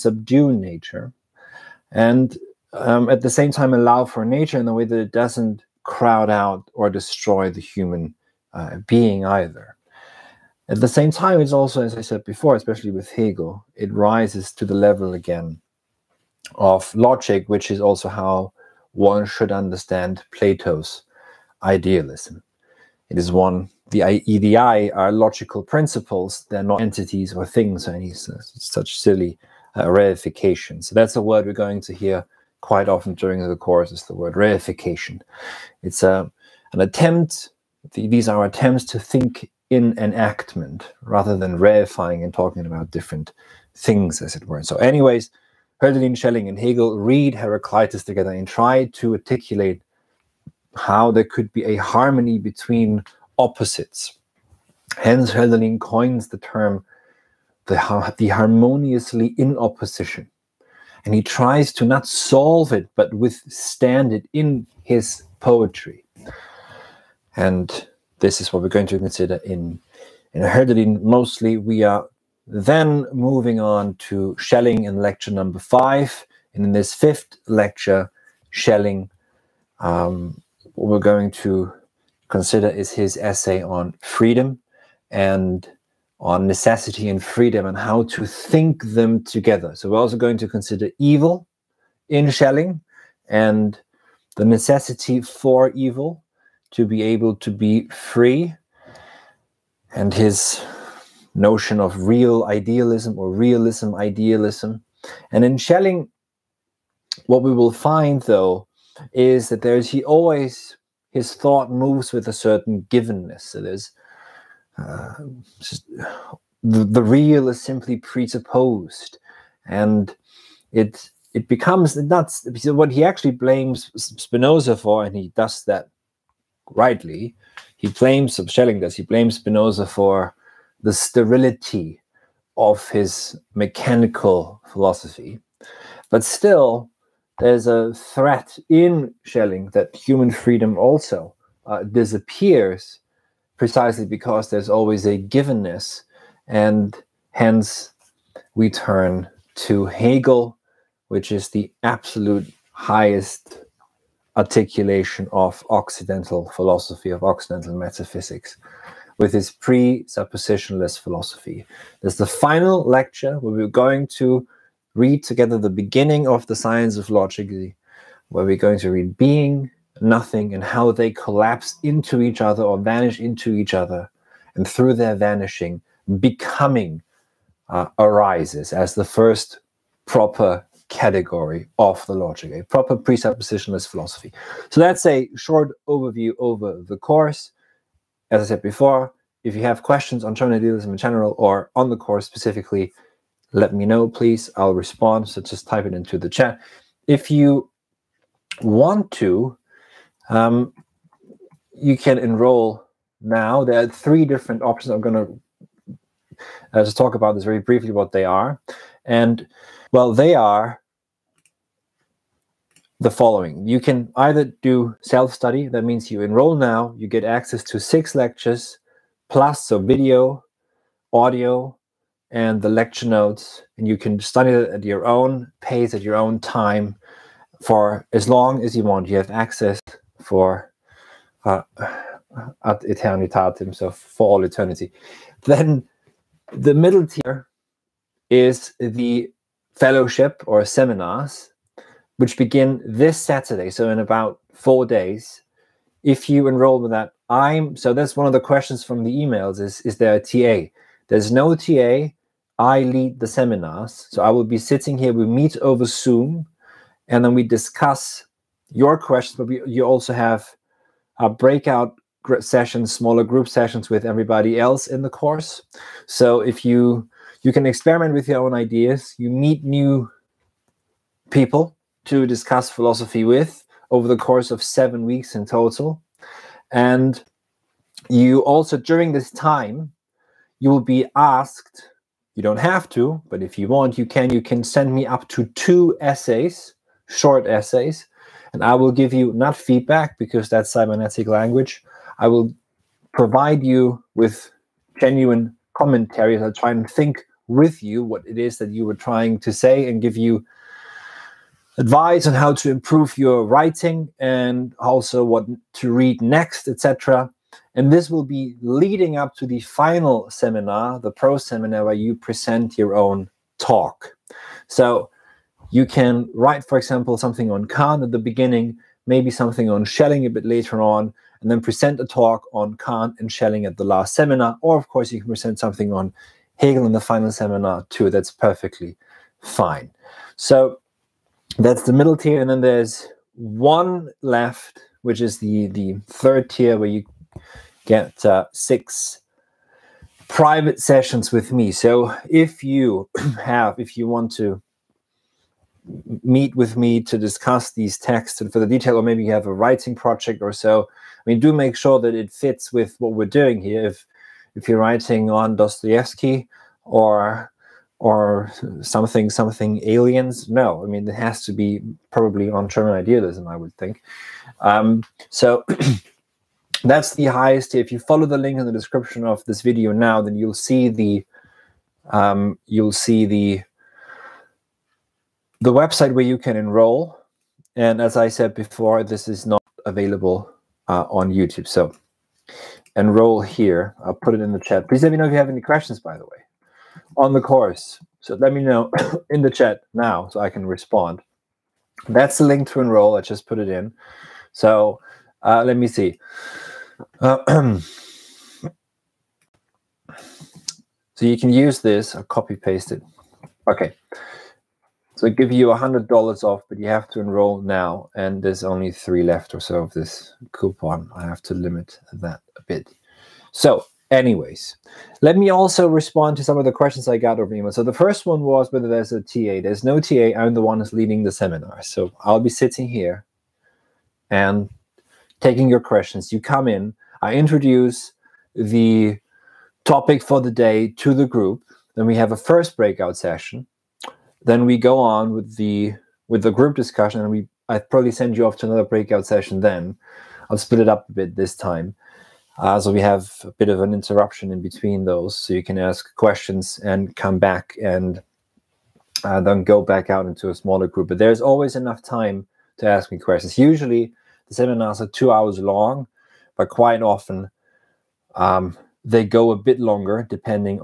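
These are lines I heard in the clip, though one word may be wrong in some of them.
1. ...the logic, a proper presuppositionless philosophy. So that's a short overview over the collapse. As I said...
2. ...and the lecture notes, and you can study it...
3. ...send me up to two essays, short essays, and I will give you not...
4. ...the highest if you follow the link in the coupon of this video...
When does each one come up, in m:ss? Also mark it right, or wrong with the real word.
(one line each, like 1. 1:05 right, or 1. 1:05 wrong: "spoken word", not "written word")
1. 3:02 wrong: "course", not "collapse"
2. 3:42 right
3. 4:44 right
4. 6:07 wrong: "description", not "coupon".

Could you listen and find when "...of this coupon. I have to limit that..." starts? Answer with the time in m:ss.
6:49.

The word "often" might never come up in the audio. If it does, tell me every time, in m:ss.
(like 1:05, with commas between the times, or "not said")
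0:32, 7:37.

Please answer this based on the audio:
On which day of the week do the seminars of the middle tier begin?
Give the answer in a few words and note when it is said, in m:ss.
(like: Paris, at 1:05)
Saturday, at 4:03.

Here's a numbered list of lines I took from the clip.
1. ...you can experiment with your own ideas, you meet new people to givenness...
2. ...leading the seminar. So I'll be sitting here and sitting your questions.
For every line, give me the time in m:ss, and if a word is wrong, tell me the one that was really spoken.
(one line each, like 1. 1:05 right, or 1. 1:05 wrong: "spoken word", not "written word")
1. 4:27 wrong: "discuss", not "givenness"
2. 7:00 wrong: "taking", not "sitting".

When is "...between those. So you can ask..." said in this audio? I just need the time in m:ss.
7:24.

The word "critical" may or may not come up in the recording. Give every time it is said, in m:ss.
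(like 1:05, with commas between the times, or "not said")
not said.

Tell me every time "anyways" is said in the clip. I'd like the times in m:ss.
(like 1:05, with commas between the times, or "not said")
0:44, 6:54.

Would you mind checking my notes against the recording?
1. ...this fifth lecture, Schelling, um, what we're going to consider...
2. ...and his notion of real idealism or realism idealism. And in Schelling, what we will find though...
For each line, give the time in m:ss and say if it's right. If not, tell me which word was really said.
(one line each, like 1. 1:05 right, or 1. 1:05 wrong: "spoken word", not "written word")
1. 1:16 right
2. 1:39 right.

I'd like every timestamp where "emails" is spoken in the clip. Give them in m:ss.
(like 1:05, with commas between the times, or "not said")
4:09, 6:57.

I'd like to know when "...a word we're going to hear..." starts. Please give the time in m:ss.
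0:31.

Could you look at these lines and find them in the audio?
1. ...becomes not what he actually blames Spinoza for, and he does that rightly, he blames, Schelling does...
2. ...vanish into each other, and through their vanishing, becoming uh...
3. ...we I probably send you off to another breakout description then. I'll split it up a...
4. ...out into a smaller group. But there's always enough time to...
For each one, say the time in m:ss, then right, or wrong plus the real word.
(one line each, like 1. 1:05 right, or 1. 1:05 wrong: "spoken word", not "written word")
1. 2:01 right
2. 2:52 right
3. 7:17 wrong: "session", not "description"
4. 7:30 right.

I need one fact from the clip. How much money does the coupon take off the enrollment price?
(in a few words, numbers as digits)
100 dollars.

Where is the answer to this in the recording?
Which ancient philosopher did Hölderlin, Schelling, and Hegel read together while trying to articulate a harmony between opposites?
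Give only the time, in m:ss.
0:47.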